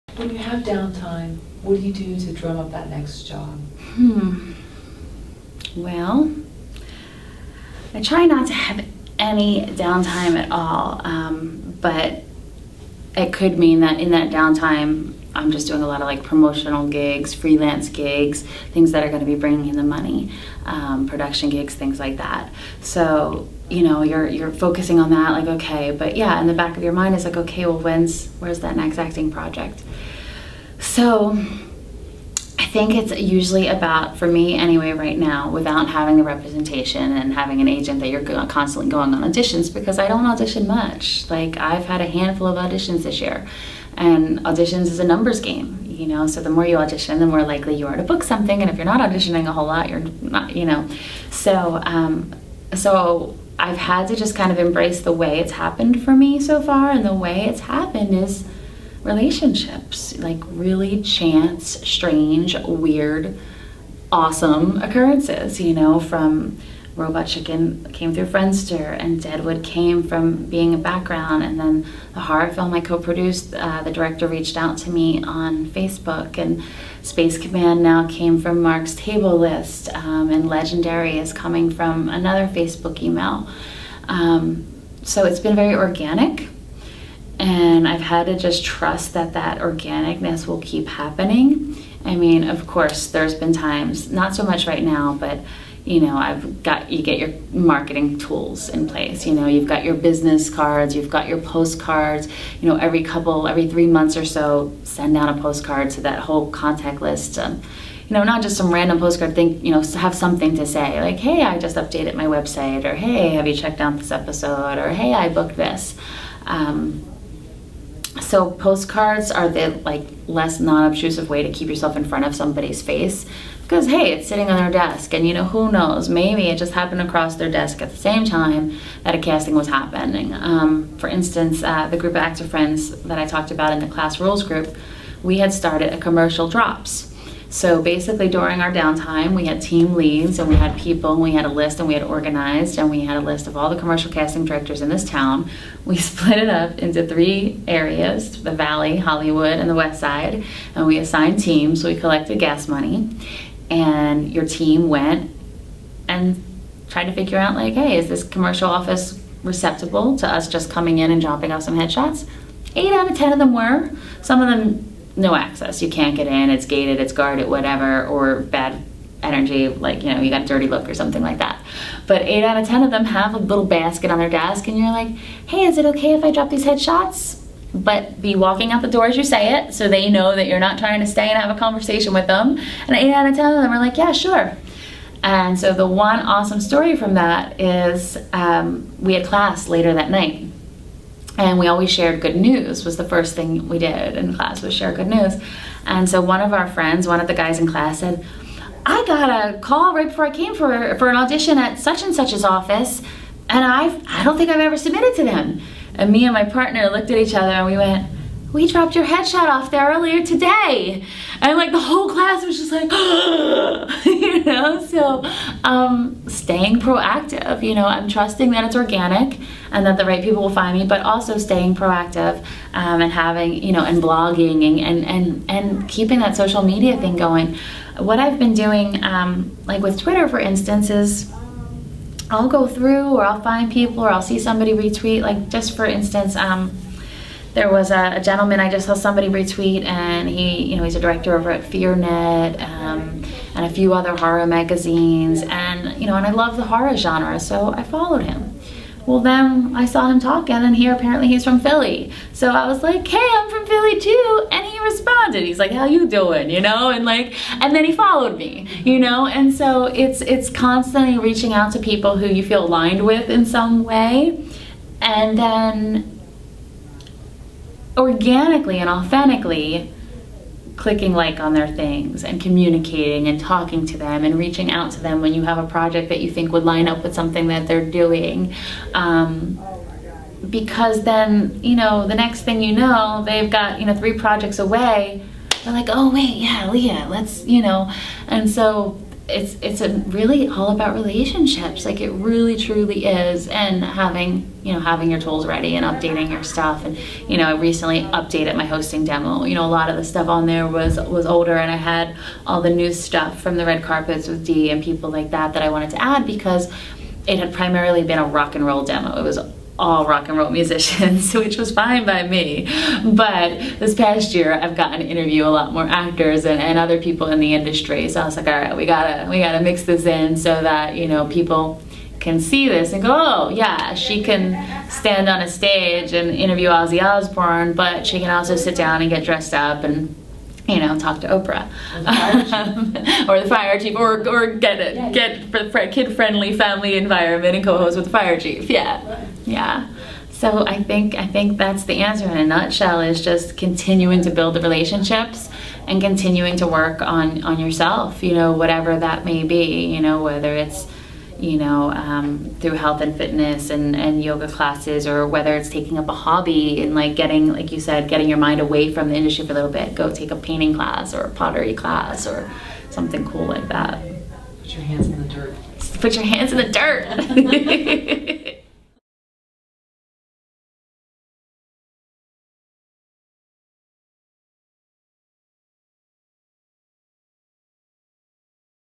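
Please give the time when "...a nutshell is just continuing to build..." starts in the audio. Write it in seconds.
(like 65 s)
342 s.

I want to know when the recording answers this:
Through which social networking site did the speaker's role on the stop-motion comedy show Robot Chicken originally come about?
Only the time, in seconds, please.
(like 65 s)
68 s.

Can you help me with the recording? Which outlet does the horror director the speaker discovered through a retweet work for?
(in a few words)
FearNet.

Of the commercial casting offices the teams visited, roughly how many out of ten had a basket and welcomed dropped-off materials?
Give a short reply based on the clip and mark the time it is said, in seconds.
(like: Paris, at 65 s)
8 out of 10, at 162 s.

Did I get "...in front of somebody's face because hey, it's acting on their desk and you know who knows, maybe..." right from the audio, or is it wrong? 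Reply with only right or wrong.
wrong.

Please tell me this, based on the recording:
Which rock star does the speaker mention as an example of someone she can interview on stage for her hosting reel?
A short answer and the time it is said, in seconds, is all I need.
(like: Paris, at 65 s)
Ozzy Osbourne, at 326 s.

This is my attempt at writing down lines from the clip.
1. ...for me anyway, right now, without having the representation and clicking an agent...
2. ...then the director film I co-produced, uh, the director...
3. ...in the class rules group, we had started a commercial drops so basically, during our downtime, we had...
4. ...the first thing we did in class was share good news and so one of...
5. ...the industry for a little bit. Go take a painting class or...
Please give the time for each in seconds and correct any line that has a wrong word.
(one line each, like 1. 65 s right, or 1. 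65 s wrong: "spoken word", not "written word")
1. 34 s wrong: "having", not "clicking"
2. 71 s wrong: "horror", not "director"
3. 133 s right
4. 192 s right
5. 359 s right.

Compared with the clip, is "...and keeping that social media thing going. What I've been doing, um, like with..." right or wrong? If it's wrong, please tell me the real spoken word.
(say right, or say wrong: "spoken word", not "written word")
right.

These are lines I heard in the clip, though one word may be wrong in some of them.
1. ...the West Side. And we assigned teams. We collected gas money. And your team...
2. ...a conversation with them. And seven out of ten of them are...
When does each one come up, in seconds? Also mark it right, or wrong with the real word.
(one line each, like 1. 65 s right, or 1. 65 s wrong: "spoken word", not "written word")
1. 149 s right
2. 181 s wrong: "eight", not "seven".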